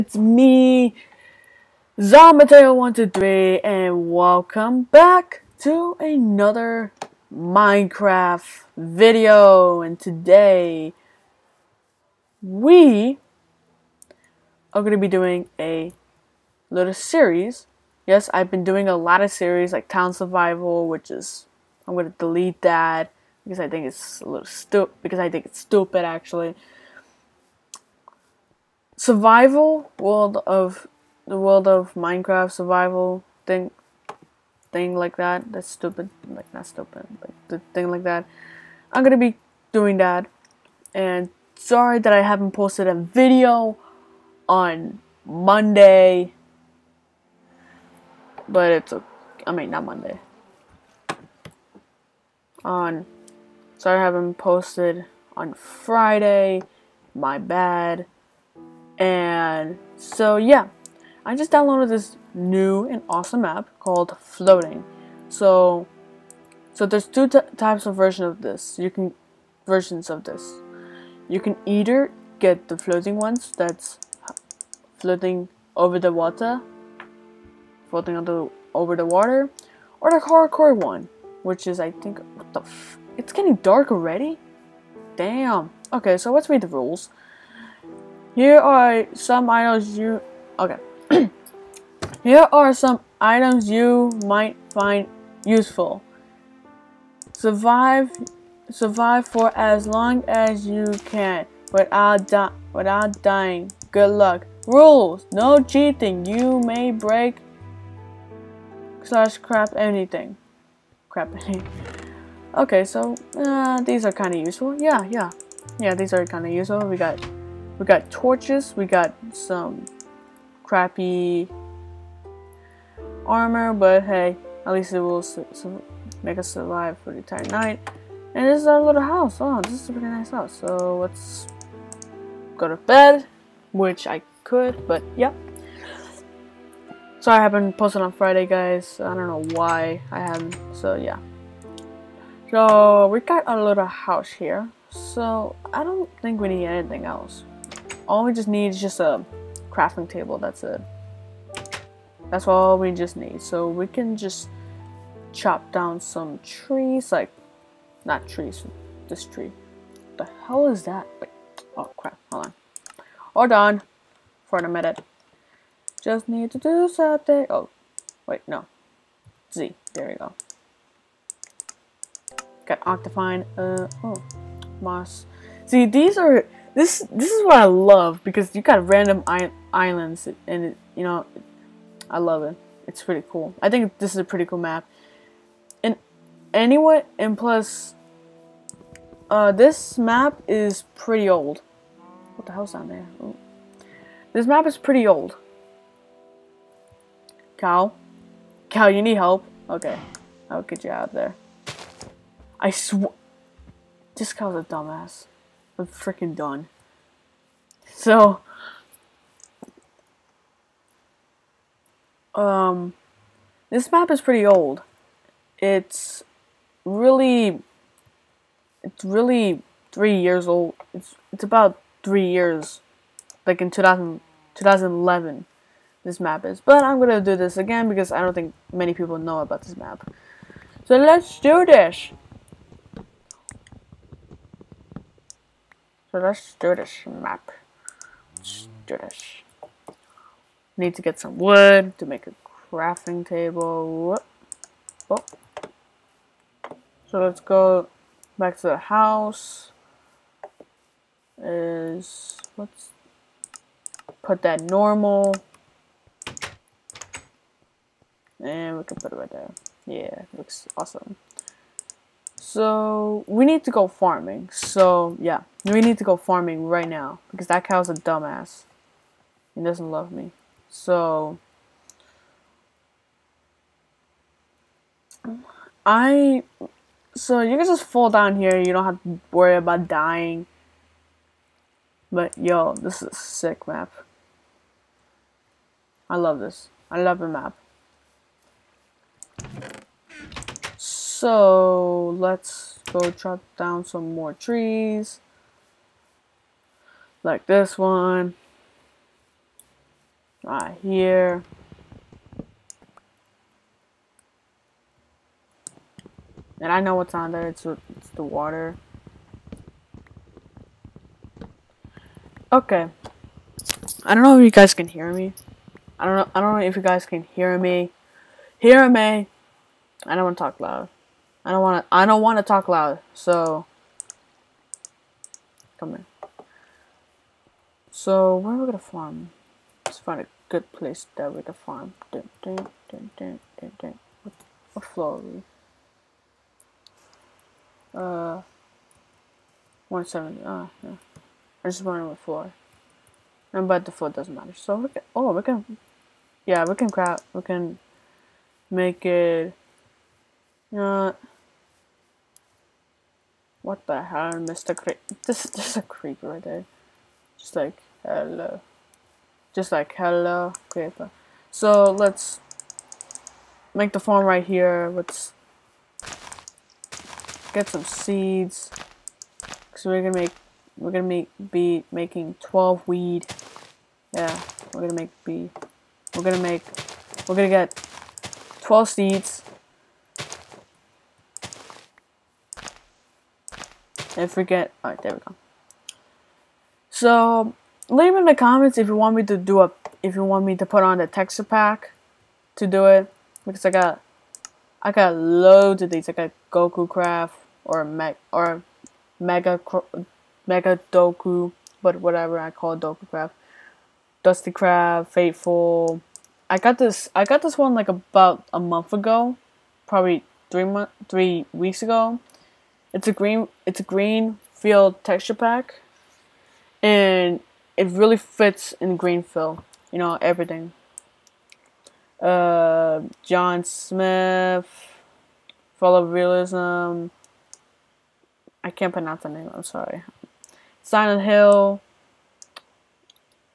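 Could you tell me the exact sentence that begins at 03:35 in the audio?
It's really, it's really three years old.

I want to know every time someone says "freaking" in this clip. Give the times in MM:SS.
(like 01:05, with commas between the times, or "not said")
03:25.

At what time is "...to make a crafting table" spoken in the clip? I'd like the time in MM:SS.
04:01.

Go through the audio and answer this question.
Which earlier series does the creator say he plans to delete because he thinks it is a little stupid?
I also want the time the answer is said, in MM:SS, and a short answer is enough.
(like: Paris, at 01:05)
Town Survival, at 00:19.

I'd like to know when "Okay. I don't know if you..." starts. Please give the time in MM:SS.
05:12.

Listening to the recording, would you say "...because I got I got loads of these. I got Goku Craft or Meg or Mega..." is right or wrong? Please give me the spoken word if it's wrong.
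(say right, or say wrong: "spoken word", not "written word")
right.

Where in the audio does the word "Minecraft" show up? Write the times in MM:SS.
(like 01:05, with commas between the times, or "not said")
00:07, 00:31.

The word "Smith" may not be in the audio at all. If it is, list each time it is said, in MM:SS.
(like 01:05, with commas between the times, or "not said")
07:03.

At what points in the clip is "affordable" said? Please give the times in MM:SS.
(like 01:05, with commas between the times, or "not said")
not said.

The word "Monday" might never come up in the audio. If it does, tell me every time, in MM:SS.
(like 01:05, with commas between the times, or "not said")
00:45, 00:49.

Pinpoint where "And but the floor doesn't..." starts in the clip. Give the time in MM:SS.
05:43.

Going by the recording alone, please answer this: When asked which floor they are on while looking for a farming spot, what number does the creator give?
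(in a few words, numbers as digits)
170.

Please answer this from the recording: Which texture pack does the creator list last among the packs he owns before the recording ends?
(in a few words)
Silent Hill.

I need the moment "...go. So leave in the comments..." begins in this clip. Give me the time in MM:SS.
06:25.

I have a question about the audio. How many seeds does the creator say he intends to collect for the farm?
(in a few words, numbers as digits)
12.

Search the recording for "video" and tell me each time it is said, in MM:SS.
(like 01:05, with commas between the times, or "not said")
00:08, 00:42.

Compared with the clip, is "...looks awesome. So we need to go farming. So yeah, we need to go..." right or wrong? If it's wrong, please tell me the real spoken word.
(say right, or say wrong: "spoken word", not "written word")
right.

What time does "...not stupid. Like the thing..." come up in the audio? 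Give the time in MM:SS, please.
00:36.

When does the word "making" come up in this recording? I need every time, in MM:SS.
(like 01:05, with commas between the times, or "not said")
06:11.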